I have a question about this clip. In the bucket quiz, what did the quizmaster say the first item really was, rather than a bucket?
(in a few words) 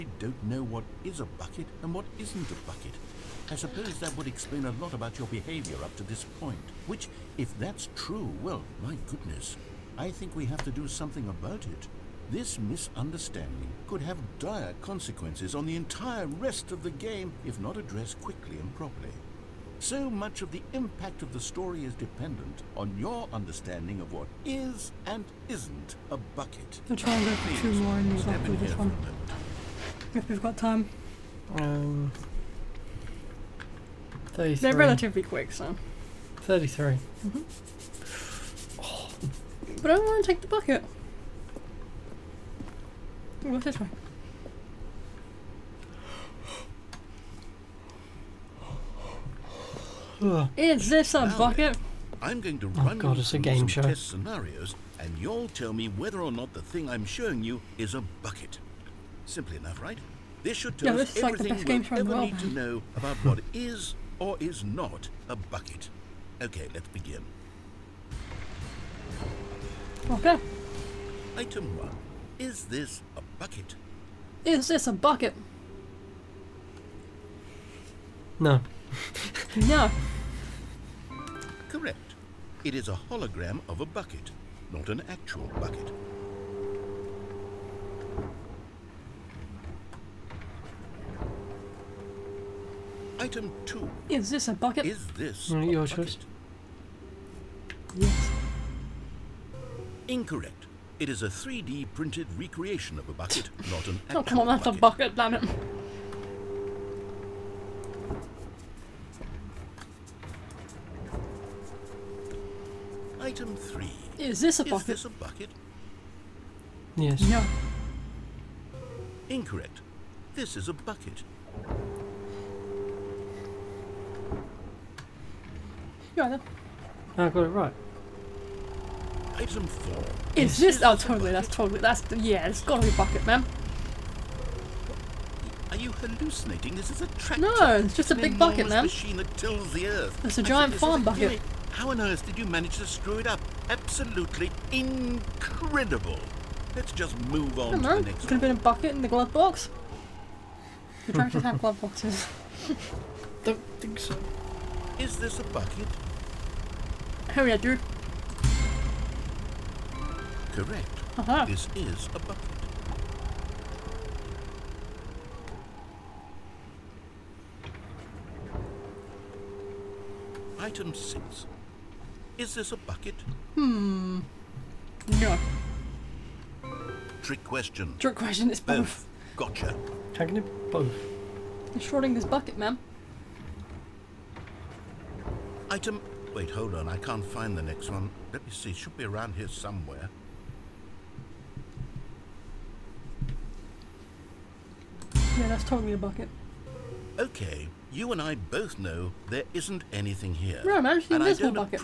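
A hologram.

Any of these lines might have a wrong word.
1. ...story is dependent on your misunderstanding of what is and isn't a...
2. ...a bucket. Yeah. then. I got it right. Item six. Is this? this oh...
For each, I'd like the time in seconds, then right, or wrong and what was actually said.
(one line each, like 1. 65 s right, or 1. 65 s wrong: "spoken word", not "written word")
1. 21 s wrong: "understanding", not "misunderstanding"
2. 120 s wrong: "four", not "six".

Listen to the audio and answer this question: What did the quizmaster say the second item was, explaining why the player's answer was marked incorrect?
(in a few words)
A 3D printed recreation.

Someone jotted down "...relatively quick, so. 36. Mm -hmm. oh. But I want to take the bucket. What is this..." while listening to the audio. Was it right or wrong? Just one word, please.
wrong.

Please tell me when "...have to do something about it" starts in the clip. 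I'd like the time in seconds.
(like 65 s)
10 s.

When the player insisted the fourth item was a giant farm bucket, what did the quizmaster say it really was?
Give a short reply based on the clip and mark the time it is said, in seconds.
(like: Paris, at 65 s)
A tractor, at 137 s.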